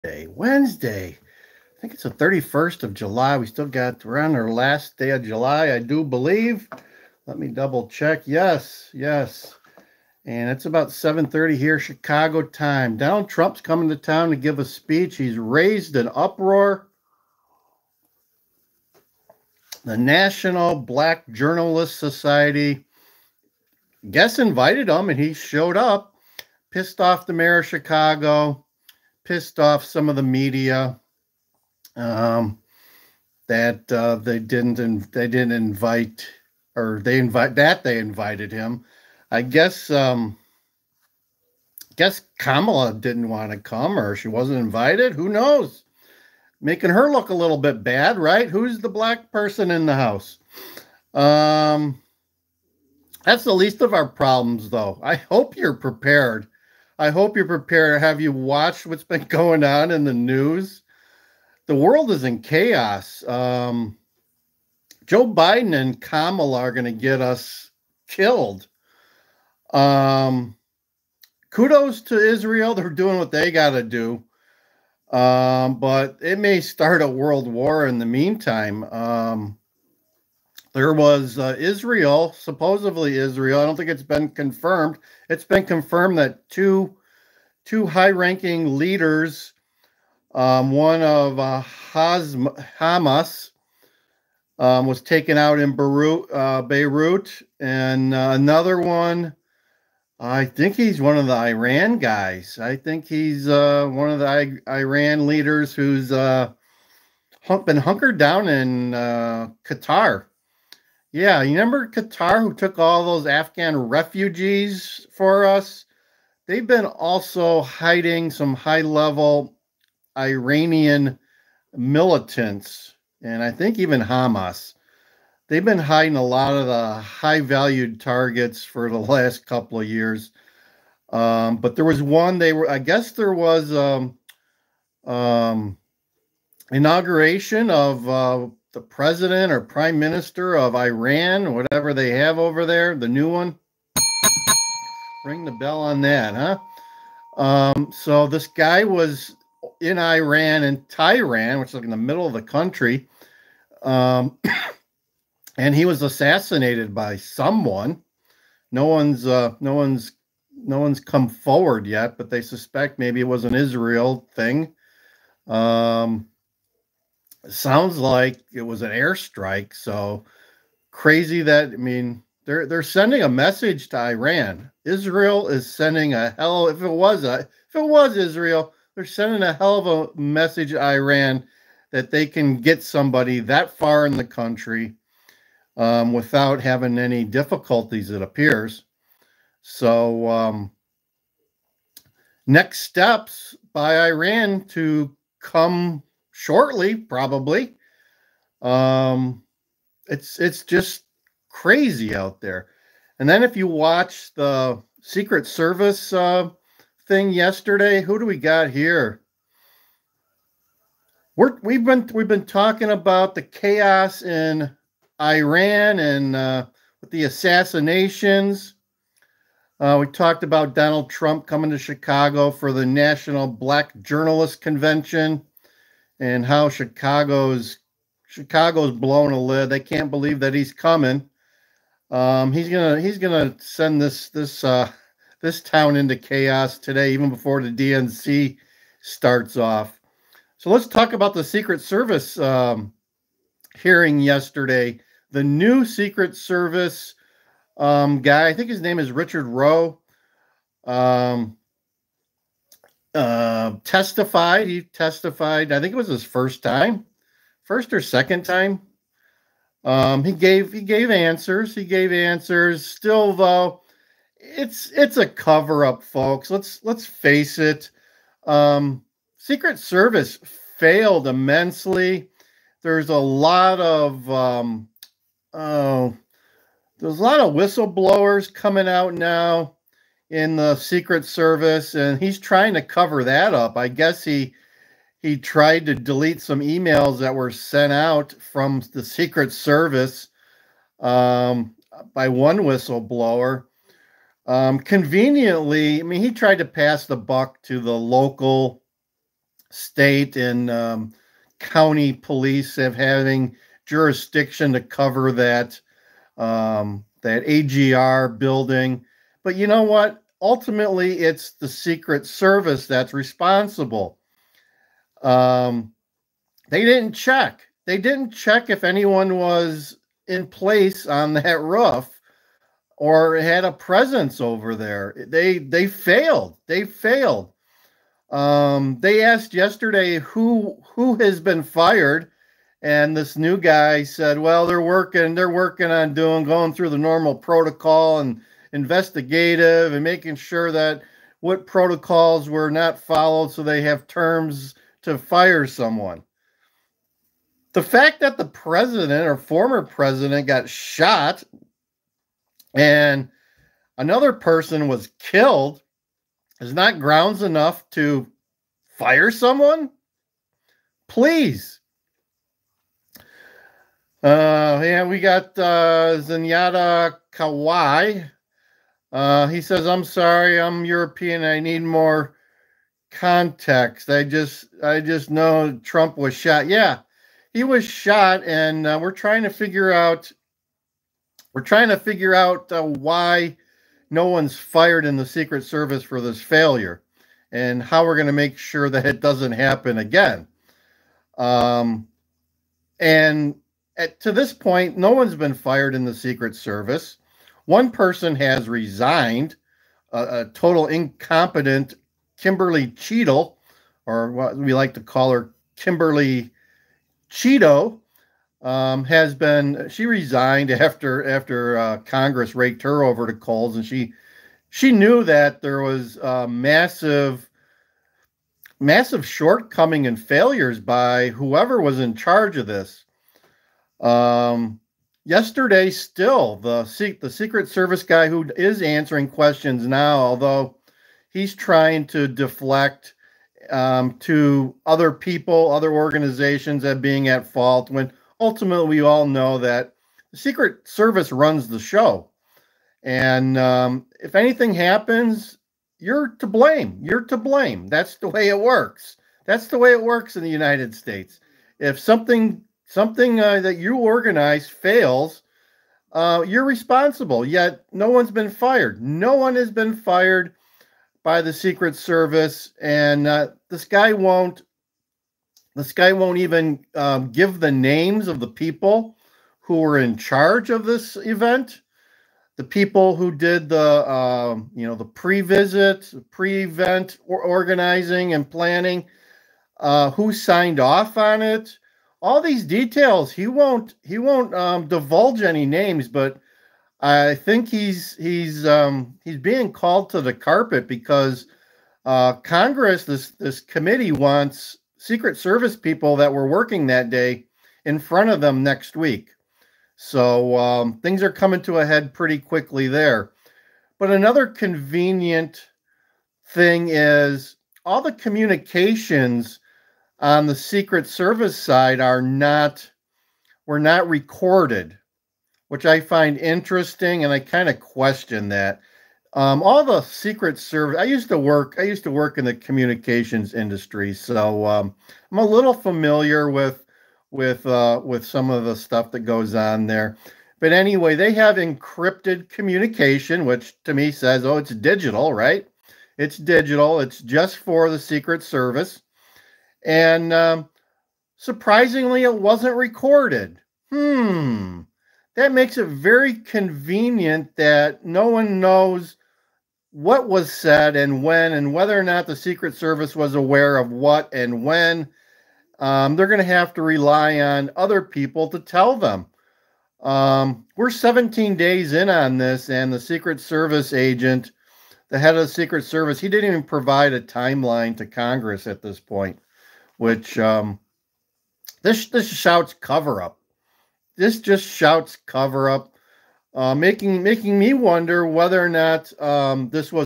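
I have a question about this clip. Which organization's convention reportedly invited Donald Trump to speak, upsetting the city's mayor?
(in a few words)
National Black Journalist Society.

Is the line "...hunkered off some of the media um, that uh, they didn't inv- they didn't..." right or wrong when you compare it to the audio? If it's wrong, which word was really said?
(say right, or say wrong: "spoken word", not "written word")
wrong: "pissed", not "hunkered".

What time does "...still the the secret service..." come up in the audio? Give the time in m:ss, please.
7:05.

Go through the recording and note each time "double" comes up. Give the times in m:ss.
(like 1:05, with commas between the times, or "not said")
0:07.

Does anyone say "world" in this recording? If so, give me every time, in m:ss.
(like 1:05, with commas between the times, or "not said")
1:01, 1:17.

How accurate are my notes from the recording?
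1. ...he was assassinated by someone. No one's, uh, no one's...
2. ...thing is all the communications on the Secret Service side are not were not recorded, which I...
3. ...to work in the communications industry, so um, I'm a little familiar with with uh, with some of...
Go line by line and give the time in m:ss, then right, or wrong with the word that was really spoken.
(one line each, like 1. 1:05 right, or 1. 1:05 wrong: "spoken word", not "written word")
1. 2:35 right
2. 8:26 right
3. 8:42 right.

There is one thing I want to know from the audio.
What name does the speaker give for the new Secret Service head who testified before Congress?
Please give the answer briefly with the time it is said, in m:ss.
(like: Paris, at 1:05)
Richard Rowe, at 4:09.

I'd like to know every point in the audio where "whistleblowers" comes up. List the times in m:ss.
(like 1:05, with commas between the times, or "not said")
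4:37, 4:52.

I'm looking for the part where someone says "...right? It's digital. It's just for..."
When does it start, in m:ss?
8:55.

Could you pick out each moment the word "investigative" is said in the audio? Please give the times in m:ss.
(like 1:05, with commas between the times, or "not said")
5:38.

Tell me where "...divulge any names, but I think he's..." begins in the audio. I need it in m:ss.
8:04.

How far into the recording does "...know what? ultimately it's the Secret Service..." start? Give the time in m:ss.
5:09.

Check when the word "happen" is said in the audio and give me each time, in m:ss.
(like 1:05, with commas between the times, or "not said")
6:29, 7:24.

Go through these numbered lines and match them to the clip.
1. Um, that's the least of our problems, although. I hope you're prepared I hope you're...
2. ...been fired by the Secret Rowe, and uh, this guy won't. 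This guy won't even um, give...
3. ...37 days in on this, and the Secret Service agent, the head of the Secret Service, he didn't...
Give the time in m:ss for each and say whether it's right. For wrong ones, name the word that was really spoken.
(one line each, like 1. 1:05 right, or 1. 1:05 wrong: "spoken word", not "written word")
1. 0:51 wrong: "though", not "although"
2. 7:39 wrong: "Service", not "Rowe"
3. 9:20 wrong: "17", not "37".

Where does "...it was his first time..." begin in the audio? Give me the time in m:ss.
4:15.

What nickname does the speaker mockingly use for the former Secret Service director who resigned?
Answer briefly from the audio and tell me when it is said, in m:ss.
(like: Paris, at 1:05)
Kimberly Cheeto, at 6:45.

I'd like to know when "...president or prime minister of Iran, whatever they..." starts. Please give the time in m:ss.
2:18.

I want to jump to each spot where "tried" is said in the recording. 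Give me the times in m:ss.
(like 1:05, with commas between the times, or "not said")
4:45, 4:56.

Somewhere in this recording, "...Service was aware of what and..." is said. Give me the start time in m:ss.
9:12.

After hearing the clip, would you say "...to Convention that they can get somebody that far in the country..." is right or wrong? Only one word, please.
wrong.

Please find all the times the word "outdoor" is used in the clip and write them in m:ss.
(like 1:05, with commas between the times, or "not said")
not said.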